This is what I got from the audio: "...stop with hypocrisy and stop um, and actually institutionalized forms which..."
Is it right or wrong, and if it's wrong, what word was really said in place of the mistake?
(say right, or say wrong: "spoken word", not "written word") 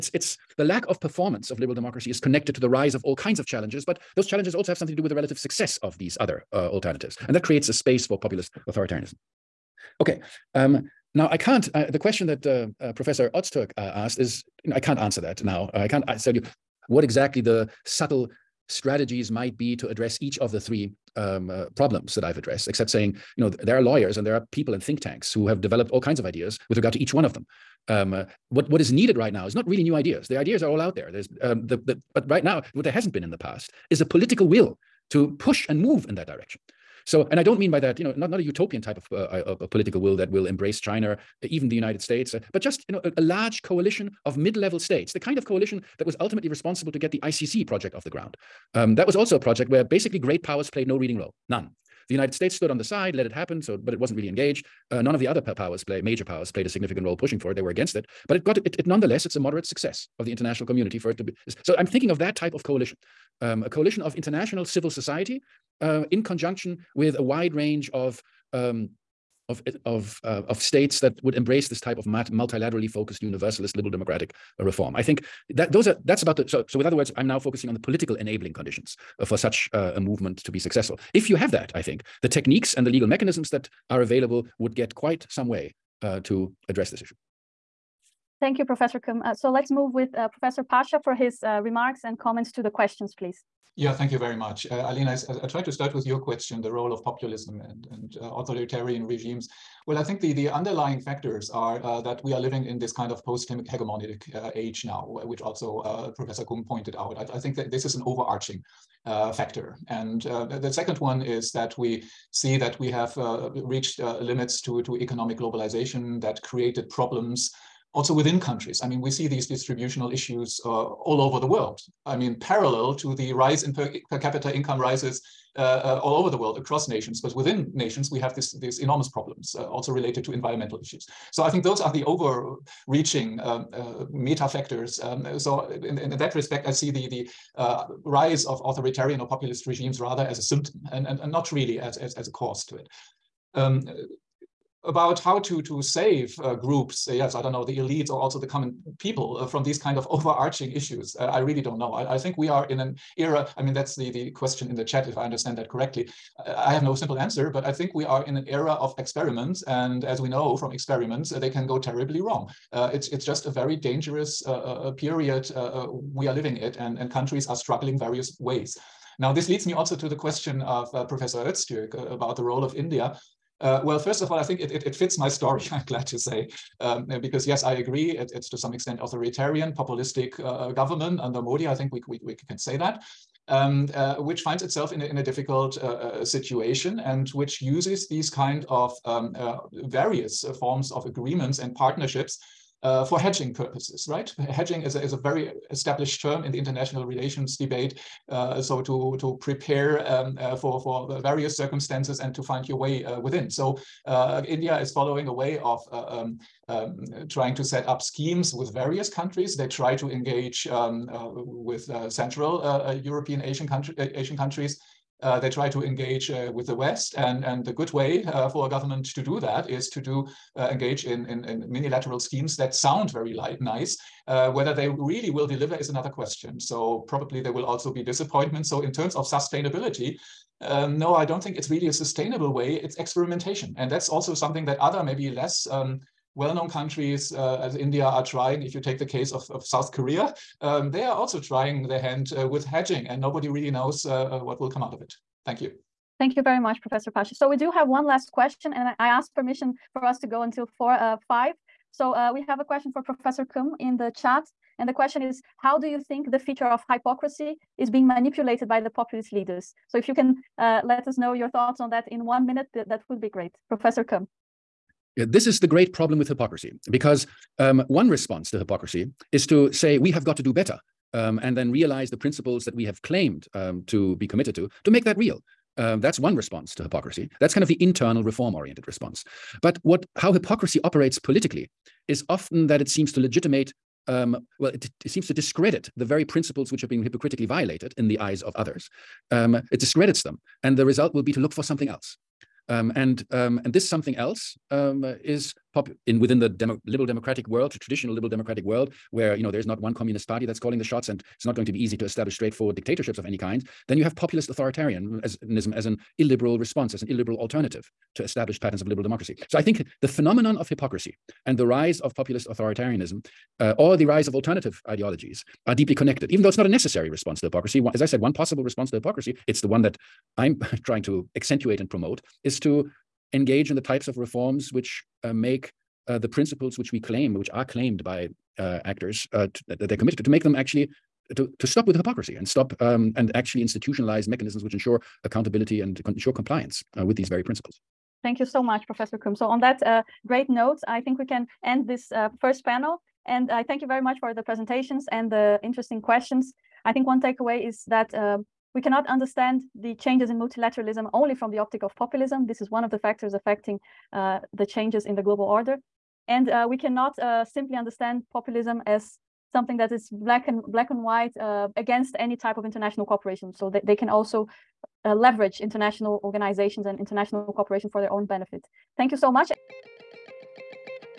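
wrong: "mechanisms", not "forms".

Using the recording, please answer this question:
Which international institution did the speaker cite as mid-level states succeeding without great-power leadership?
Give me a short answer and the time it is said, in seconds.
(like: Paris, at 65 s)
ICC, at 47 s.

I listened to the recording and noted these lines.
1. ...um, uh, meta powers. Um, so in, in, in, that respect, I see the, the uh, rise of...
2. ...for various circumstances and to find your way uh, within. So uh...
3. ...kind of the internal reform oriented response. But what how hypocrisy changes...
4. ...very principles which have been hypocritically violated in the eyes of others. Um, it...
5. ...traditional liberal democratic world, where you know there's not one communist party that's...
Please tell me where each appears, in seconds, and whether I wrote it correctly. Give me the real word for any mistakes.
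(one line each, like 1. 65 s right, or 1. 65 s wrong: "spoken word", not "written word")
1. 133 s wrong: "factors", not "powers"
2. 200 s right
3. 277 s wrong: "operates", not "changes"
4. 286 s right
5. 297 s right.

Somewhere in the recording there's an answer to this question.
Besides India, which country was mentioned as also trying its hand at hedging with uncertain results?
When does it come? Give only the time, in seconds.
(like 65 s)
239 s.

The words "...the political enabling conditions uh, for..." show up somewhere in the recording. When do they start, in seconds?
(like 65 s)
77 s.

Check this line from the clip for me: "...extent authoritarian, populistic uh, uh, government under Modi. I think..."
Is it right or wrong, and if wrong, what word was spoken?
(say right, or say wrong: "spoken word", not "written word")
right.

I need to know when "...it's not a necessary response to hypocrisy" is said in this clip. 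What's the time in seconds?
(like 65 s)
316 s.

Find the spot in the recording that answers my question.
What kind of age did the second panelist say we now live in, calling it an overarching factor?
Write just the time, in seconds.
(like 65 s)
103 s.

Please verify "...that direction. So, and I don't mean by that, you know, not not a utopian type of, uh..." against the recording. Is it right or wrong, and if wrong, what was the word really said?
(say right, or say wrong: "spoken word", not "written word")
right.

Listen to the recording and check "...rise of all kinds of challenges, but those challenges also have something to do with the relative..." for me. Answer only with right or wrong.
right.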